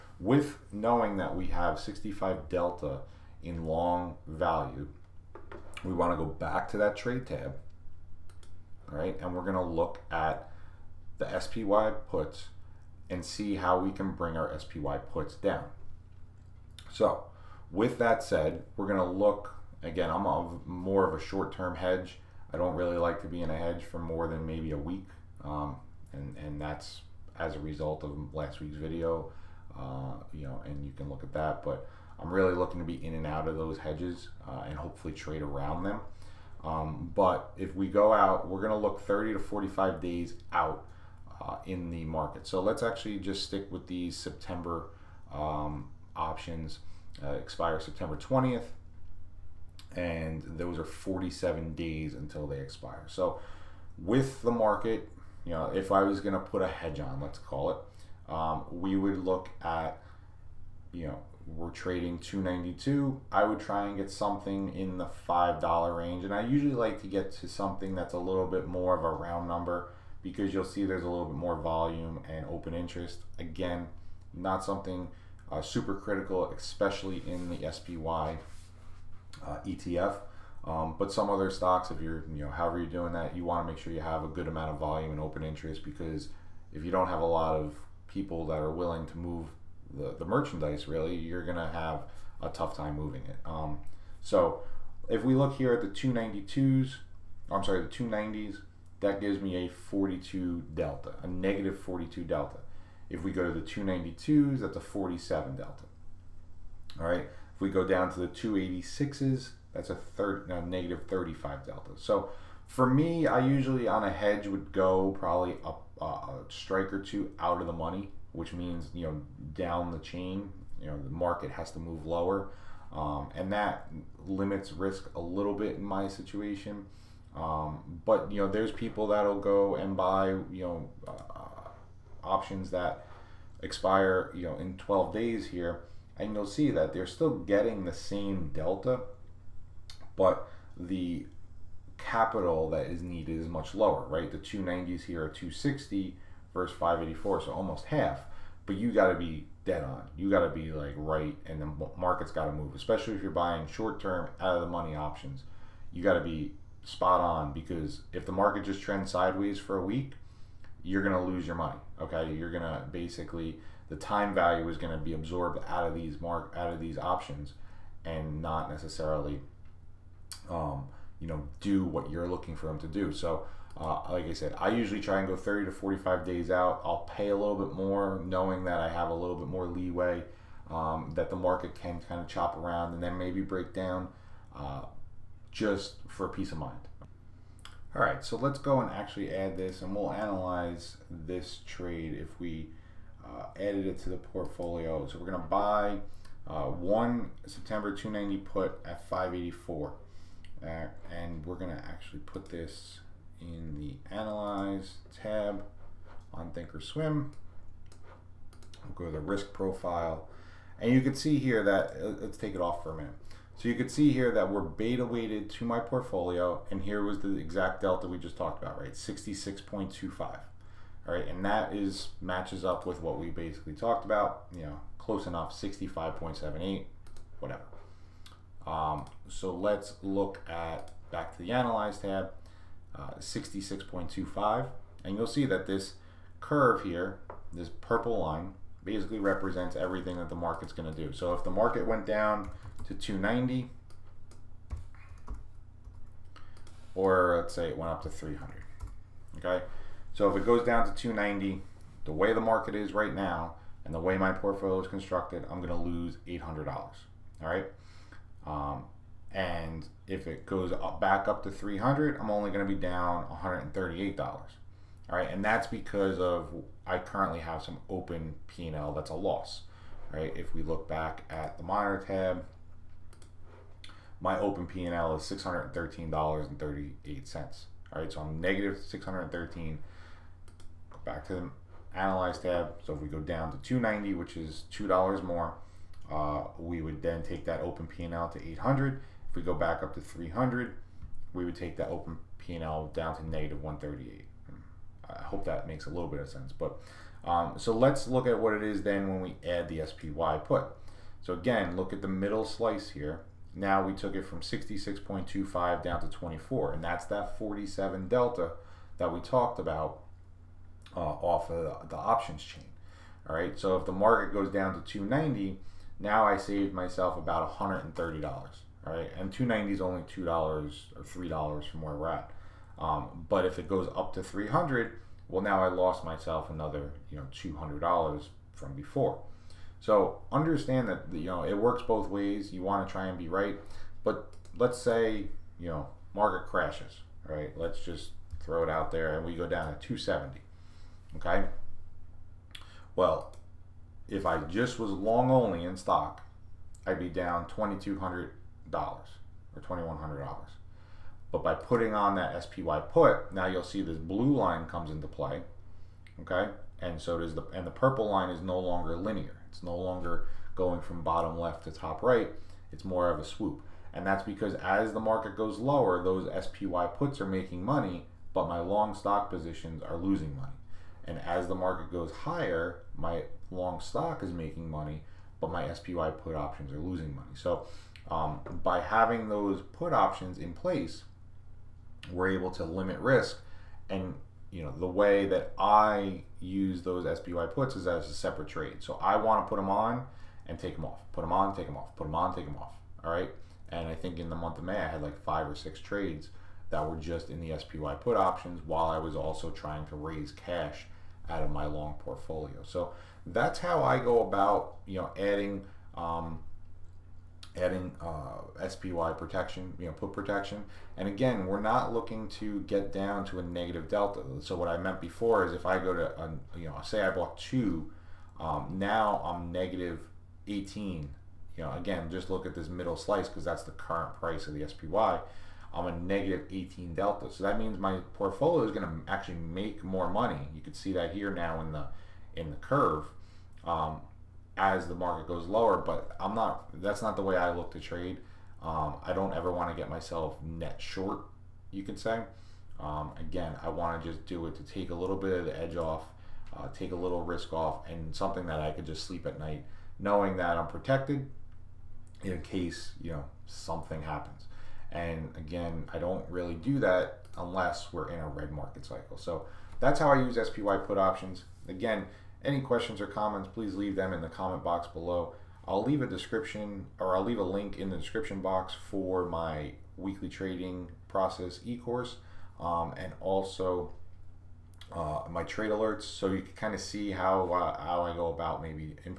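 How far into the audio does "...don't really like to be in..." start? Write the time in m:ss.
0:22.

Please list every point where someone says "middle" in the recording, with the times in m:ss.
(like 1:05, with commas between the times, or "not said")
5:02, 7:02.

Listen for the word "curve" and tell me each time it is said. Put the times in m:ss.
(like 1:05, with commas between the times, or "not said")
3:56, 7:12.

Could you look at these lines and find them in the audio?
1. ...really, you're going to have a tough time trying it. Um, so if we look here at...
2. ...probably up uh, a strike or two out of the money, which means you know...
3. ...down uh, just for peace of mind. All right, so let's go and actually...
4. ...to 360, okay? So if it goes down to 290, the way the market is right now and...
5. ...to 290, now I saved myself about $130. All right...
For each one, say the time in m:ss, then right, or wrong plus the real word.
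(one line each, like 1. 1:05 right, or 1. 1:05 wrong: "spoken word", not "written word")
1. 1:30 wrong: "moving", not "trying"
2. 1:55 right
3. 3:03 right
4. 4:08 wrong: "300", not "360"
5. 5:14 right.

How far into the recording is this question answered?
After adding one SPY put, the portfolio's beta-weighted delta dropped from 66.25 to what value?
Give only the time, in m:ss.
5:06.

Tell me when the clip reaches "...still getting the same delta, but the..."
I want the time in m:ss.
2:17.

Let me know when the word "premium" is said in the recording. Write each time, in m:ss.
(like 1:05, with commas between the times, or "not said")
not said.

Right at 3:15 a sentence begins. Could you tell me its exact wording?
So we're going to buy uh, one September 290 put at 584.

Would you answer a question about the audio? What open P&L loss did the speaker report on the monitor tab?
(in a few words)
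$613.38.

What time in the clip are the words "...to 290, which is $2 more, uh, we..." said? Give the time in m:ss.
4:43.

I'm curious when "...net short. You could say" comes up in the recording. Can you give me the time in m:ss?
7:20.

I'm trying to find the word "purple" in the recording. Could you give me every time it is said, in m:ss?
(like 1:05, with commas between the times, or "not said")
3:57, 5:57.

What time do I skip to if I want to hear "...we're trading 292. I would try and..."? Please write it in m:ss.
1:01.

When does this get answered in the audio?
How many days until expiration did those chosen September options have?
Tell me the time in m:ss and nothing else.
0:50.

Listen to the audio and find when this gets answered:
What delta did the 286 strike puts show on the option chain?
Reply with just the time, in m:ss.
1:50.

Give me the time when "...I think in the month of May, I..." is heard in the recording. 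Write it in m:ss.
6:33.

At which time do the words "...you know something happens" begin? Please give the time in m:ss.
7:33.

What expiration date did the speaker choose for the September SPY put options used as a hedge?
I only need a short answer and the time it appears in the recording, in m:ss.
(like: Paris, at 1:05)
September 20th, at 0:47.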